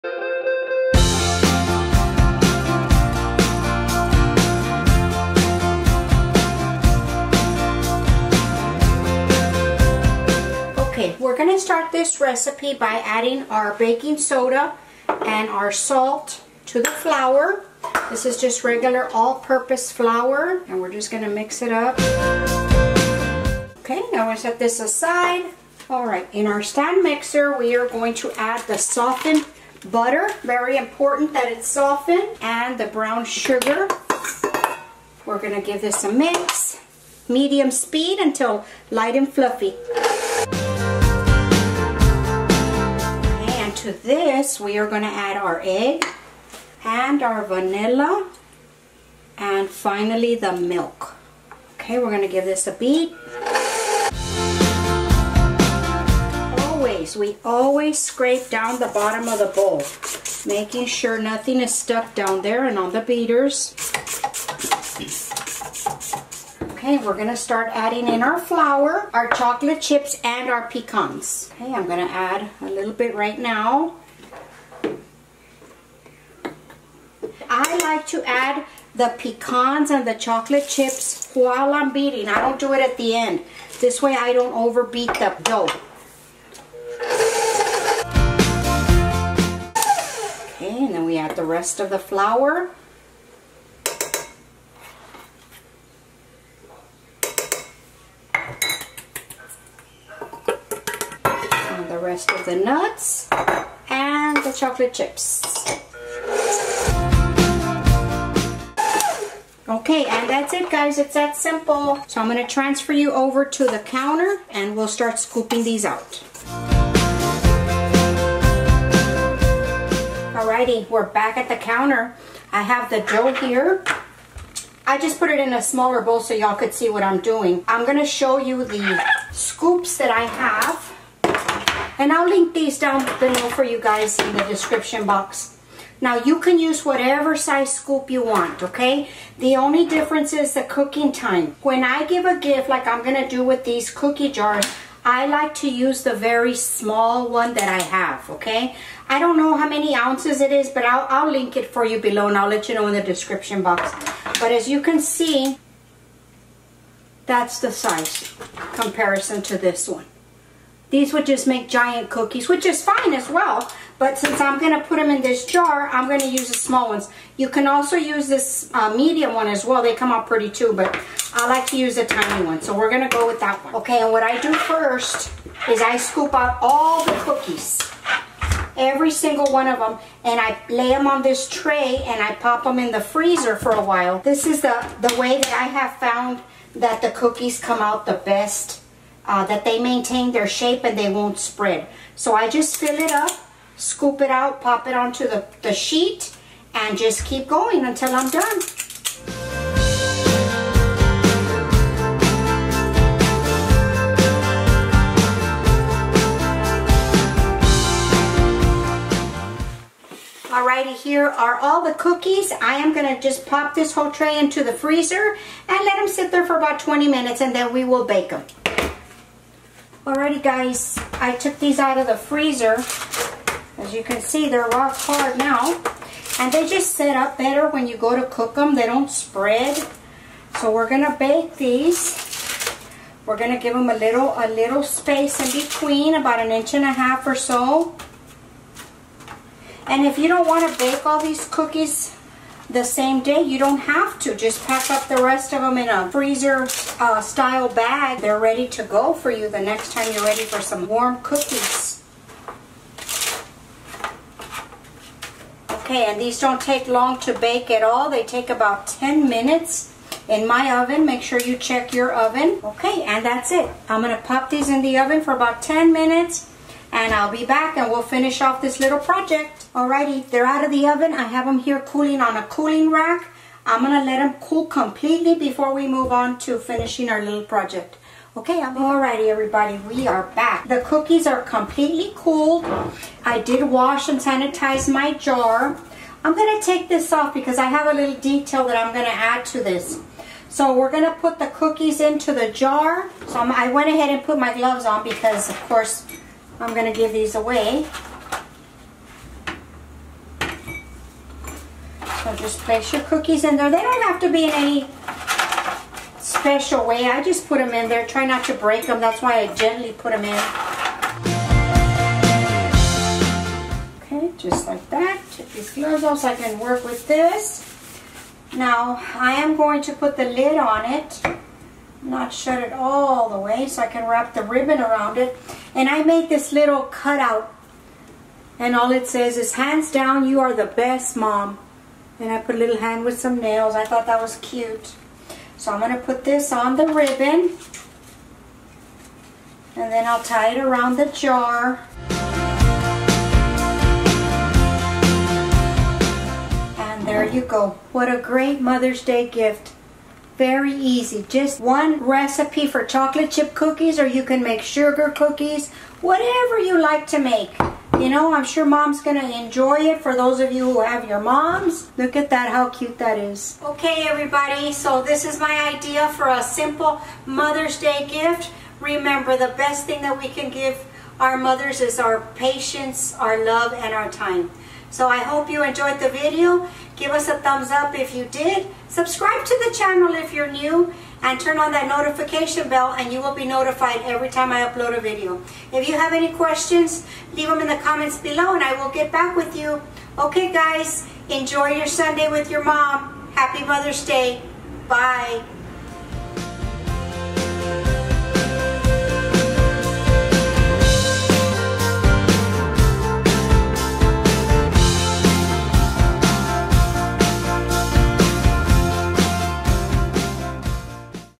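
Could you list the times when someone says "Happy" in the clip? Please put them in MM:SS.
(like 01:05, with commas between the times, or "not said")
06:33.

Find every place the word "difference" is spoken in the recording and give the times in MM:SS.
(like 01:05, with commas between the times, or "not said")
02:19.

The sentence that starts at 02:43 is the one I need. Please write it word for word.
But since I'm going to put them in this jar, I'm going to use the small ones.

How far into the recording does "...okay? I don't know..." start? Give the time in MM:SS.
02:28.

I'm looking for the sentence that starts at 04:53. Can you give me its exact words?
So I'm, I went ahead and put my gloves on because of course I'm going to give these away.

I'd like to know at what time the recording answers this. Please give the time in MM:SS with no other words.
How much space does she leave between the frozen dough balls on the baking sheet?
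03:56.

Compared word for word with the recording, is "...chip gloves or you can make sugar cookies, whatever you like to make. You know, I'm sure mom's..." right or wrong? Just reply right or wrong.
wrong.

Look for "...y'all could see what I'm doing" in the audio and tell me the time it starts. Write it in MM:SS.
02:06.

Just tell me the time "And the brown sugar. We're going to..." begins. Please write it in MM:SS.
00:32.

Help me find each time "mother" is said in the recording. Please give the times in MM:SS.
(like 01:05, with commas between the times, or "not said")
05:48, 06:07, 06:11, 06:33.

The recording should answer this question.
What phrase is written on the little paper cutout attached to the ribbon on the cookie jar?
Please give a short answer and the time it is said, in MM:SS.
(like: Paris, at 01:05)
Hands down, you are the best mom, at 05:29.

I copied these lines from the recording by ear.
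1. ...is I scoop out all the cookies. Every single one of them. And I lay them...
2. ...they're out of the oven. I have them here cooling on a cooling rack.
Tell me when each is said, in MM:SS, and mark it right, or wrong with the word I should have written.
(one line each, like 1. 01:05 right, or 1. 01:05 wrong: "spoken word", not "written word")
1. 02:55 right
2. 04:30 right.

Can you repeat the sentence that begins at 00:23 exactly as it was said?
Okay, now we set this aside.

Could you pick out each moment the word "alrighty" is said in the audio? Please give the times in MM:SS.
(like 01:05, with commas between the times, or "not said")
02:00, 03:30, 03:40, 04:29, 04:38.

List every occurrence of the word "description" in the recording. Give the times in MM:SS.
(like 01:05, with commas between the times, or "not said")
02:14, 02:33.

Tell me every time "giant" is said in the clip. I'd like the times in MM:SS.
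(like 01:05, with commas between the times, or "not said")
02:41.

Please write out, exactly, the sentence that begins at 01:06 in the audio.
Okay, we're gonna start adding in our flour, our chocolate chips, and our pecans.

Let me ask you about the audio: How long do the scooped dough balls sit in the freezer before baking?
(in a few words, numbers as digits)
20 minutes.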